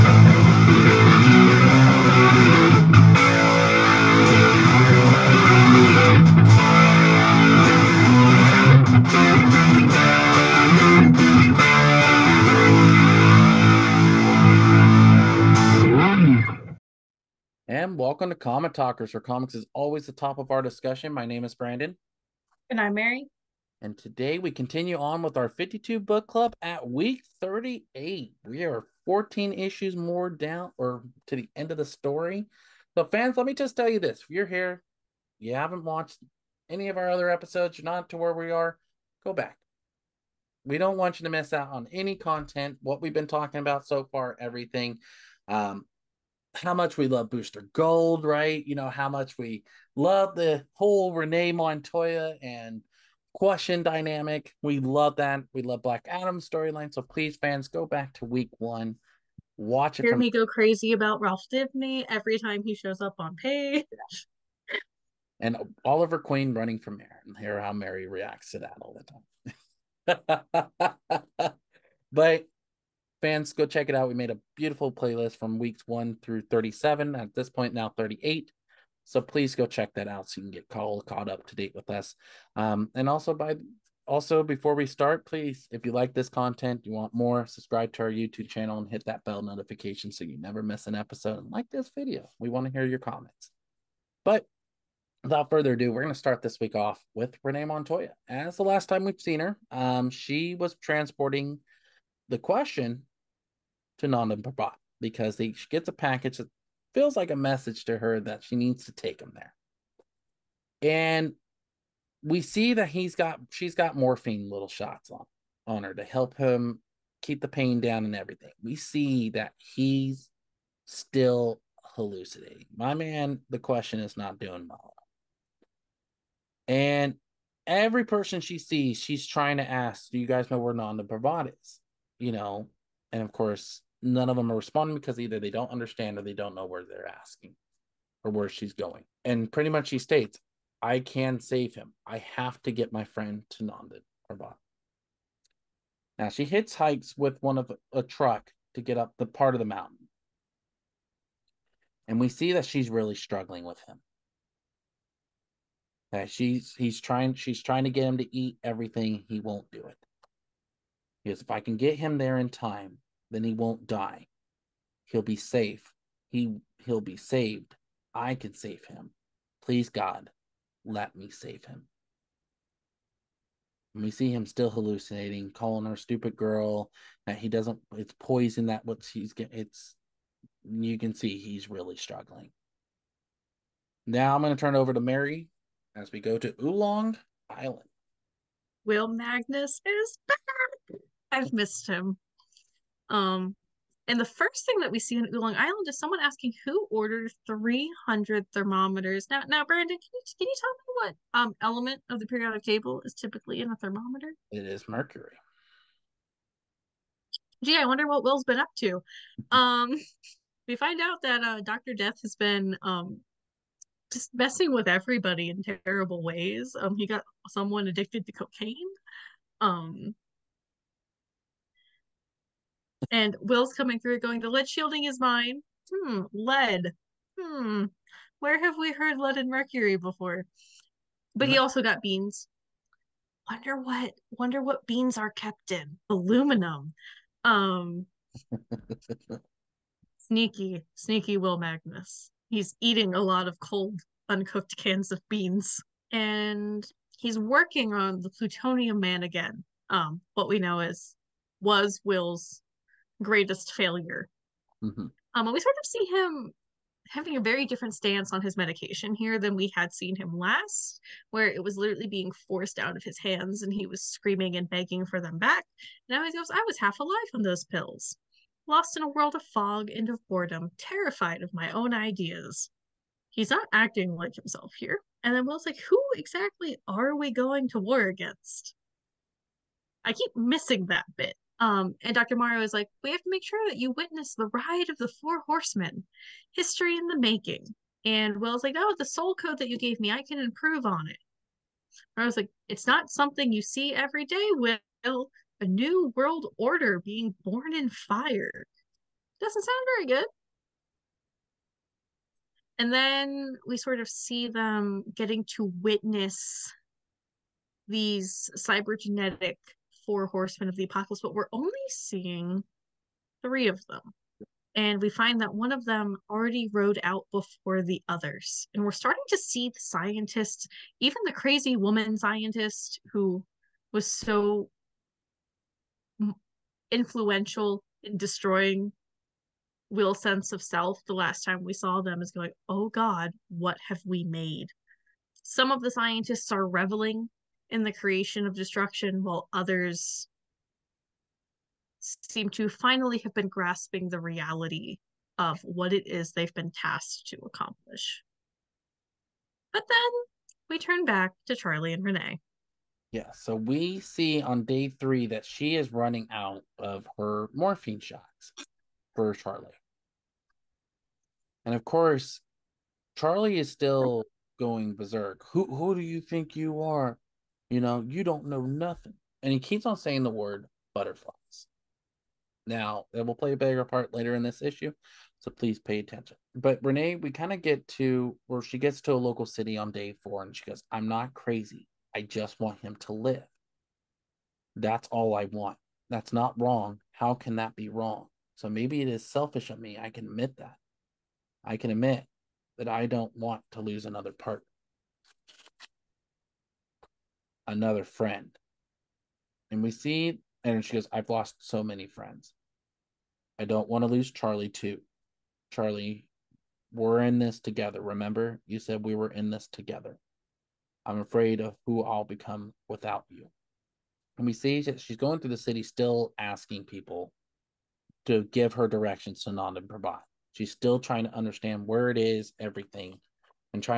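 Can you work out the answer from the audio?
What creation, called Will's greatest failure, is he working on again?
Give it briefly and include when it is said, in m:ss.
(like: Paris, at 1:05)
Plutonium man, at 4:08.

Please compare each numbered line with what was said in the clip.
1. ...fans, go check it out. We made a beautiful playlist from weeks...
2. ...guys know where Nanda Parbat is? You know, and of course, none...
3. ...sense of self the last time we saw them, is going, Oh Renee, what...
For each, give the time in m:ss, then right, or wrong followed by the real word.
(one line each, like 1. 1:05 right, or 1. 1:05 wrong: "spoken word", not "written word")
1. 1:13 right
2. 2:10 right
3. 5:30 wrong: "God", not "Renee".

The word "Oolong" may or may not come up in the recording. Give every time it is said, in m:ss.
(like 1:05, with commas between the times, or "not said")
3:06, 3:15.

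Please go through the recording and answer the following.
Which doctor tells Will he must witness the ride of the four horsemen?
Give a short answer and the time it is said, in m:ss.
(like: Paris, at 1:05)
Dr. Morrow, at 4:42.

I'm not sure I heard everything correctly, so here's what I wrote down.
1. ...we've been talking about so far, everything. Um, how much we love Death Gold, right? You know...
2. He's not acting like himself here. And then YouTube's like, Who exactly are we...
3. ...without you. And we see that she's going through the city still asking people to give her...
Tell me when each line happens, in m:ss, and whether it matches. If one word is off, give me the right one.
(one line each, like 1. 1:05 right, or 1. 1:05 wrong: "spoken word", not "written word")
1. 0:43 wrong: "Booster", not "Death"
2. 4:33 wrong: "Will", not "YouTube"
3. 6:52 right.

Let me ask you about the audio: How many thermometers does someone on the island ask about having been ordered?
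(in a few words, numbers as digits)
300.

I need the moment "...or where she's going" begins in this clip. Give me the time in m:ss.
2:18.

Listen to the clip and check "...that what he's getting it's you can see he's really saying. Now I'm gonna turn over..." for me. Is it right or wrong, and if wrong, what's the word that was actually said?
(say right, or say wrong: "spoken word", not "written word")
wrong: "struggling", not "saying".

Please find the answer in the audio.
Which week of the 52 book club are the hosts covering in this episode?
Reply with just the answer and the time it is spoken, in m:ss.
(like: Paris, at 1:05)
38, at 0:26.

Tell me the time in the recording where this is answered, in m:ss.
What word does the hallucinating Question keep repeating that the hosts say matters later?
6:10.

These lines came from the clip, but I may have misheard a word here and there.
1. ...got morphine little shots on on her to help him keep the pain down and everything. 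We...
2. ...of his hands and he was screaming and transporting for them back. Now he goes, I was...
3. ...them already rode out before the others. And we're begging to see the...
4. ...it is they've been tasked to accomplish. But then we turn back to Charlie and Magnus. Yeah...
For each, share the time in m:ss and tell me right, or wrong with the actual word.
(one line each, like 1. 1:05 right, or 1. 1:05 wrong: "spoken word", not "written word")
1. 1:53 right
2. 4:22 wrong: "begging", not "transporting"
3. 5:15 wrong: "starting", not "begging"
4. 5:45 wrong: "Renee", not "Magnus".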